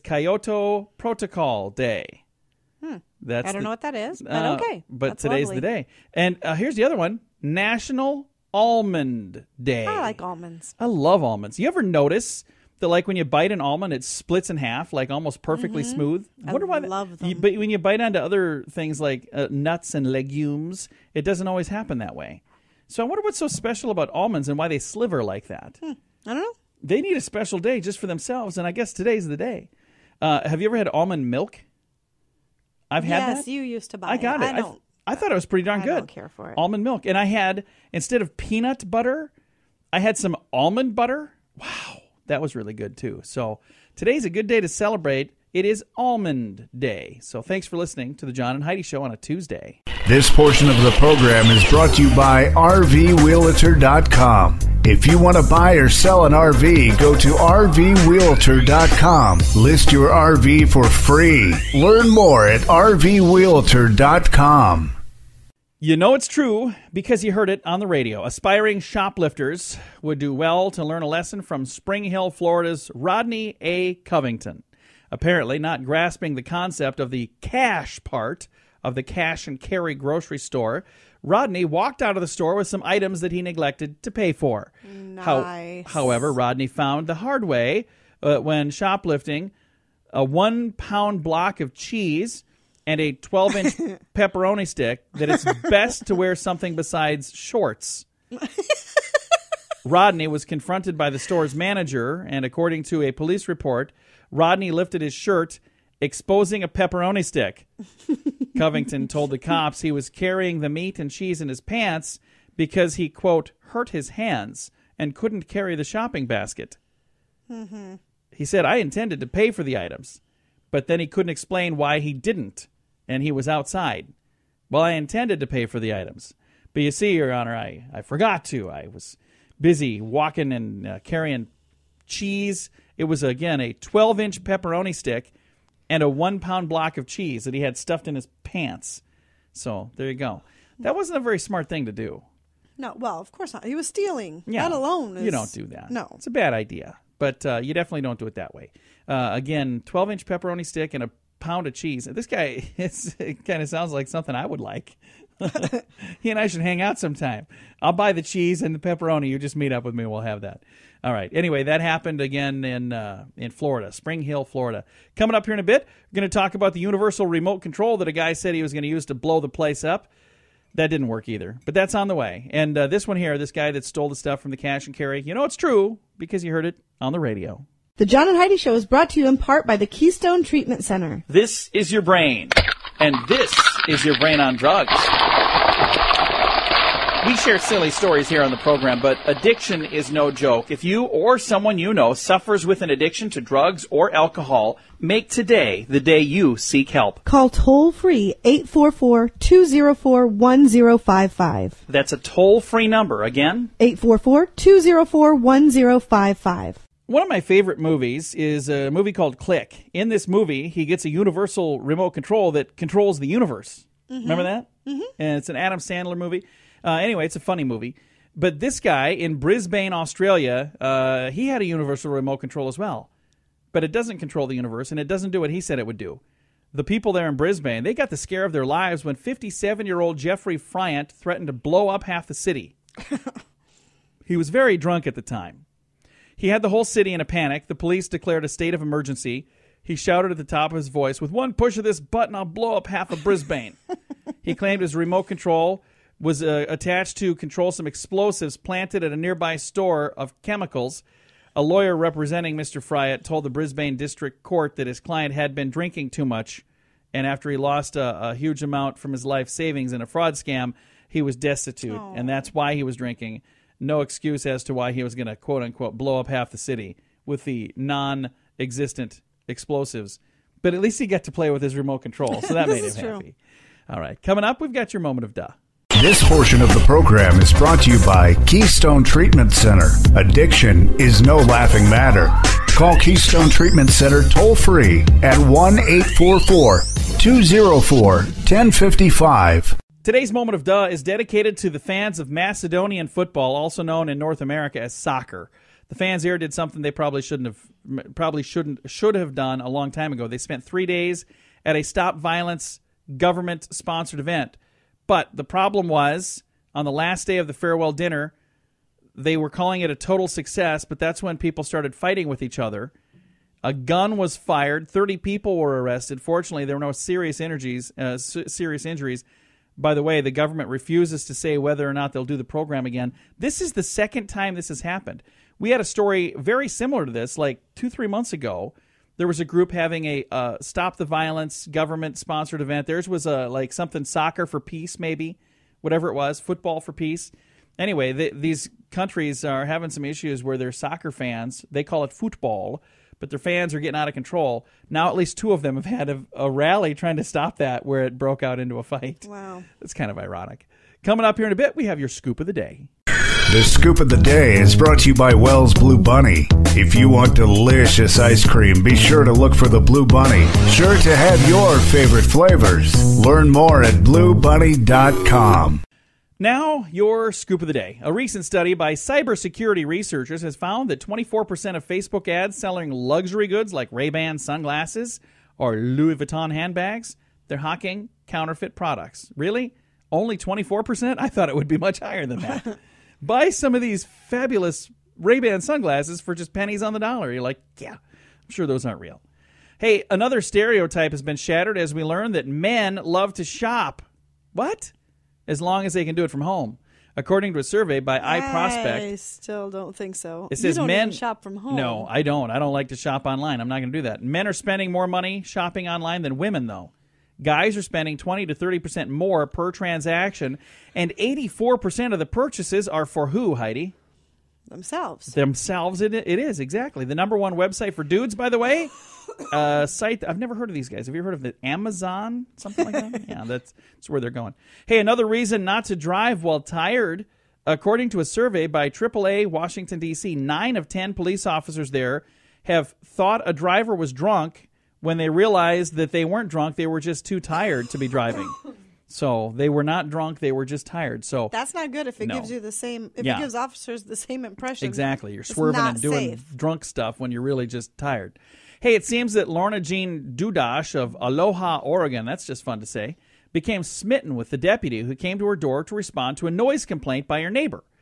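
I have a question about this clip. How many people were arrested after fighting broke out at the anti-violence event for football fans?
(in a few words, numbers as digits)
30.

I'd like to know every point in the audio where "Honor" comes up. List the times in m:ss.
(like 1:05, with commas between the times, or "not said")
2:07.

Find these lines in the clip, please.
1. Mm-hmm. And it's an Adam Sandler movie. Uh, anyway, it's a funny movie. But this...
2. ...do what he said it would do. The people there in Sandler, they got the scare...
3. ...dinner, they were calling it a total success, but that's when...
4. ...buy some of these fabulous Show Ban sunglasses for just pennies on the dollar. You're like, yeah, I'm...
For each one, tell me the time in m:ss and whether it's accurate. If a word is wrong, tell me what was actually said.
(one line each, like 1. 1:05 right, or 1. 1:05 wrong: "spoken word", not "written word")
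1. 3:34 right
2. 3:45 wrong: "Brisbane", not "Sandler"
3. 5:07 right
4. 6:23 wrong: "Ray", not "Show".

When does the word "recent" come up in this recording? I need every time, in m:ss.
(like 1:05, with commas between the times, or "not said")
6:08.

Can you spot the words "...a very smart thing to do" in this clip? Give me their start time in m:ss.
2:21.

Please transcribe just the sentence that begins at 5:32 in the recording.
Theirs was a uh, like something soccer for peace, maybe whatever it was, football for peace.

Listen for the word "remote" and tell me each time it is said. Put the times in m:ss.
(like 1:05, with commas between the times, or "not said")
2:47, 3:31, 3:42, 4:04, 4:31.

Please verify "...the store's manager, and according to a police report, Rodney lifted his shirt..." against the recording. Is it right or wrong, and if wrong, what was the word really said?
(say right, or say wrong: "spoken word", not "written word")
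right.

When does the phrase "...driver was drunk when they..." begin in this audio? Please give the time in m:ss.
7:13.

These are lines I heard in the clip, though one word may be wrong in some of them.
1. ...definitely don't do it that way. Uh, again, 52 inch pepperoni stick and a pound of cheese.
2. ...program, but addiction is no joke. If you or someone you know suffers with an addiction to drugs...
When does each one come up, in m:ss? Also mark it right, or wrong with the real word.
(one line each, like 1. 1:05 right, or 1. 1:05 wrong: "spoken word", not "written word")
1. 2:27 wrong: "12", not "52"
2. 3:08 right.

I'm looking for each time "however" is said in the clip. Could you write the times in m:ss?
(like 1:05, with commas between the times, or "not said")
1:26.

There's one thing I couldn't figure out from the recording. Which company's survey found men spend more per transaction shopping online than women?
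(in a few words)
iProspect.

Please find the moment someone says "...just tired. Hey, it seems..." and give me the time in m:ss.
7:27.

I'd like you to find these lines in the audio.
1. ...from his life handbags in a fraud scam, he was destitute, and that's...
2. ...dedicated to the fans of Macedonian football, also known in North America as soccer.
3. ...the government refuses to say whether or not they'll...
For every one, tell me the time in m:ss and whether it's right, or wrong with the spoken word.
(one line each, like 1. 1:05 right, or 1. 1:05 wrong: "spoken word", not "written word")
1. 4:18 wrong: "savings", not "handbags"
2. 4:51 right
3. 5:20 right.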